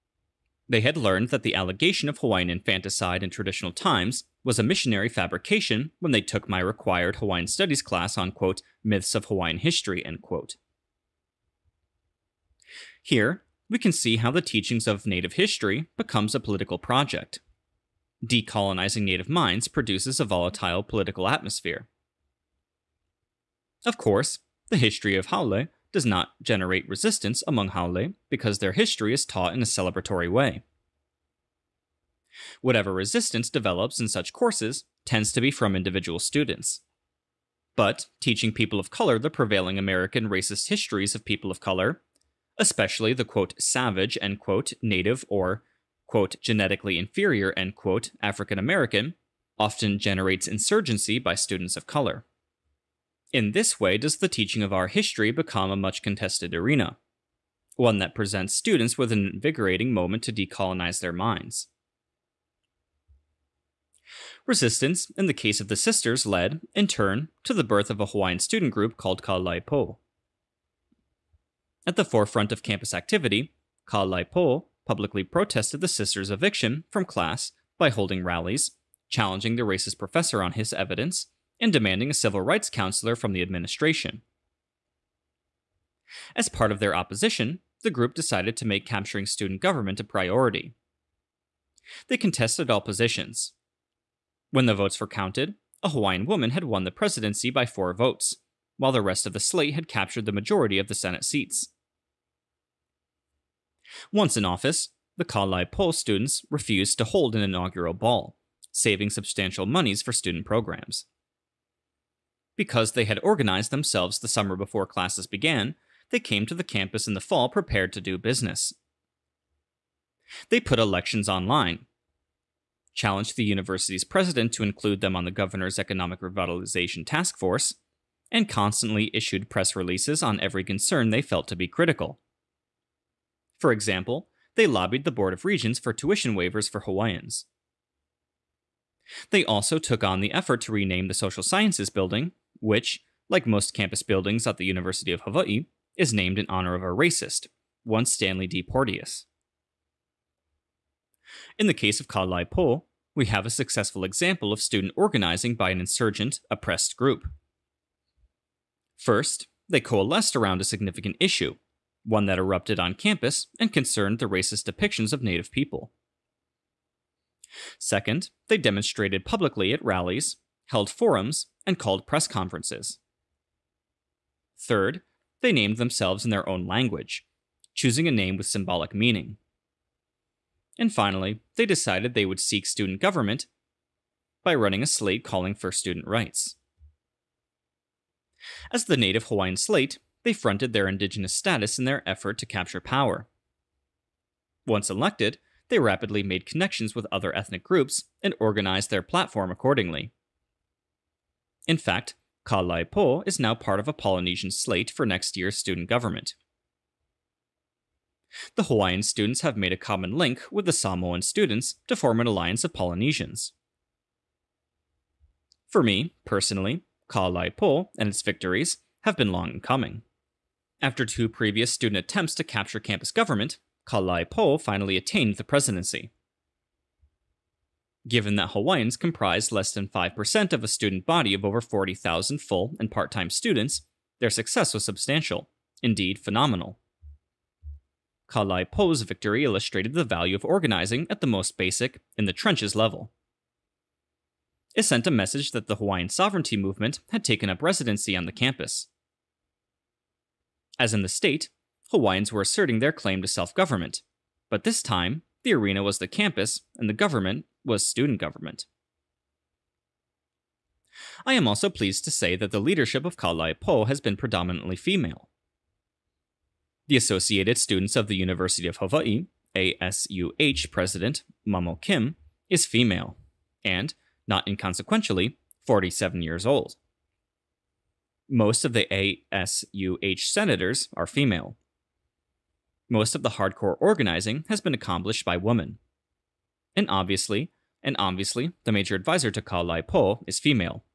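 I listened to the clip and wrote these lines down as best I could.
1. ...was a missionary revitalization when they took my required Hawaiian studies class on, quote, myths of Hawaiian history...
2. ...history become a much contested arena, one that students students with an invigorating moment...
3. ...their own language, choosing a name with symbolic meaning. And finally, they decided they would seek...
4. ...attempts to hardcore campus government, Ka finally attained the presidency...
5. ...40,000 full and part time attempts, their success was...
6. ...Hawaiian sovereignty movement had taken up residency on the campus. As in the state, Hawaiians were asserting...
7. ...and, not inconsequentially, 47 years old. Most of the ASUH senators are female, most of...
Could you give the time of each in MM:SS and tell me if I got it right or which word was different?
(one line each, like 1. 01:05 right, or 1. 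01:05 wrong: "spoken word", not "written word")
1. 00:04 wrong: "fabrication", not "revitalization"
2. 00:54 wrong: "presents", not "students"
3. 02:56 right
4. 03:41 wrong: "capture", not "hardcore"
5. 03:51 wrong: "students", not "attempts"
6. 04:05 right
7. 04:33 right.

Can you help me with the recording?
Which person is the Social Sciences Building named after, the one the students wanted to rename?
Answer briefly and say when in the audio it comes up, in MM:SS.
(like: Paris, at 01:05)
Stanley D. Porteus, at 02:28.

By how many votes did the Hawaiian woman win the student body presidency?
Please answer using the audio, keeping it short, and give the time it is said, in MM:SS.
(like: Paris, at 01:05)
4, at 01:37.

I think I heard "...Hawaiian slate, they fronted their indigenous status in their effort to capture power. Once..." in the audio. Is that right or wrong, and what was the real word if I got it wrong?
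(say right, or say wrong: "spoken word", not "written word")
right.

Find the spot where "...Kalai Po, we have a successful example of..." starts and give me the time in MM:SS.
02:32.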